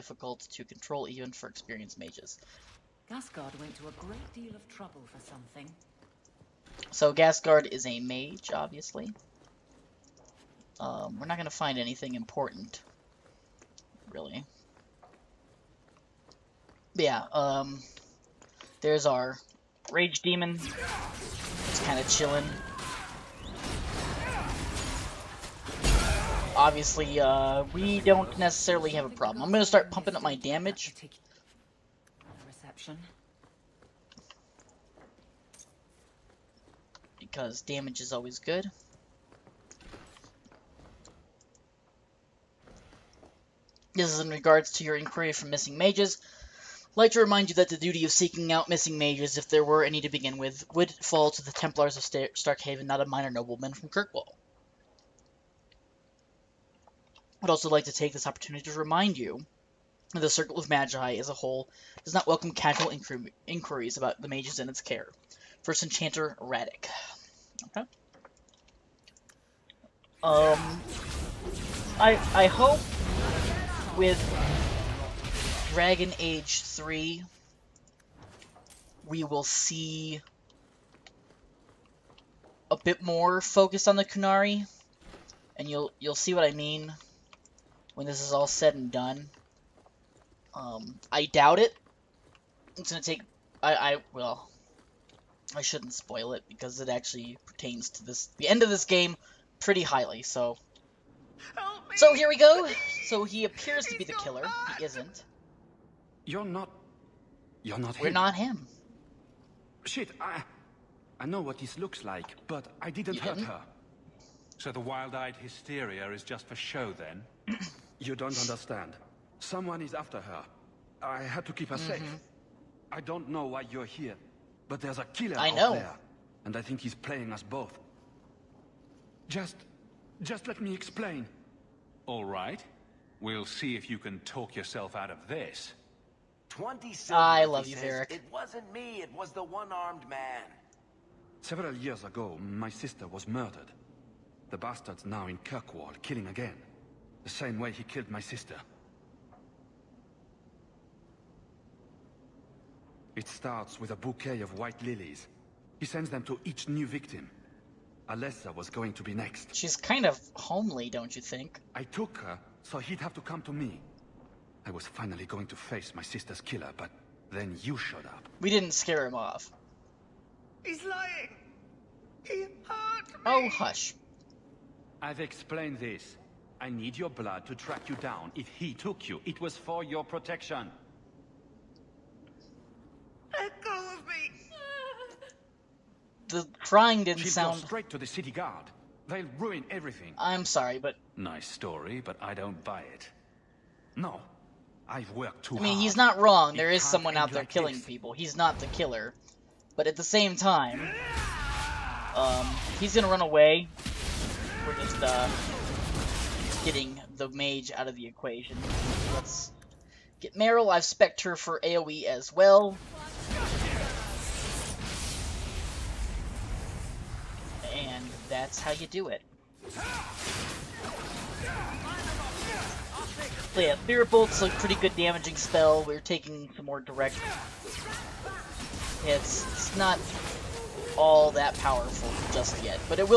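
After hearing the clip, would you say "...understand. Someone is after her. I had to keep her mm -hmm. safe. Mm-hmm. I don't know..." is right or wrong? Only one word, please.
right.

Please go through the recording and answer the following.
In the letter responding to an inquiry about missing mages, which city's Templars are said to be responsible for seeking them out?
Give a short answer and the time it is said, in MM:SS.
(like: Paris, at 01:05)
Starkhaven, at 00:52.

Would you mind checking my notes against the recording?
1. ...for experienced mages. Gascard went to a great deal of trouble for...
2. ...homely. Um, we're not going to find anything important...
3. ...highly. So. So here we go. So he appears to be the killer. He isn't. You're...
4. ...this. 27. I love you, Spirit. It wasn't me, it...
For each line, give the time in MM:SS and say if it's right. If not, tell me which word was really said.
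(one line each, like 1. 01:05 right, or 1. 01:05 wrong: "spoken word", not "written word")
1. 00:01 right
2. 00:08 wrong: "obviously", not "homely"
3. 01:39 right
4. 02:15 wrong: "Eric", not "Spirit".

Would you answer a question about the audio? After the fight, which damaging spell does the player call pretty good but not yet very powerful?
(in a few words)
Spirit Bolt.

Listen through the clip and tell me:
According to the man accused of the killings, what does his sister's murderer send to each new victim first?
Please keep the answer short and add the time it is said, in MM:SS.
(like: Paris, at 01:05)
A bouquet of white lilies, at 02:33.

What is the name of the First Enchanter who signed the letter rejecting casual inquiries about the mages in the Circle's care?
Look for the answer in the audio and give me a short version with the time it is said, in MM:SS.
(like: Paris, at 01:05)
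Radic, at 01:06.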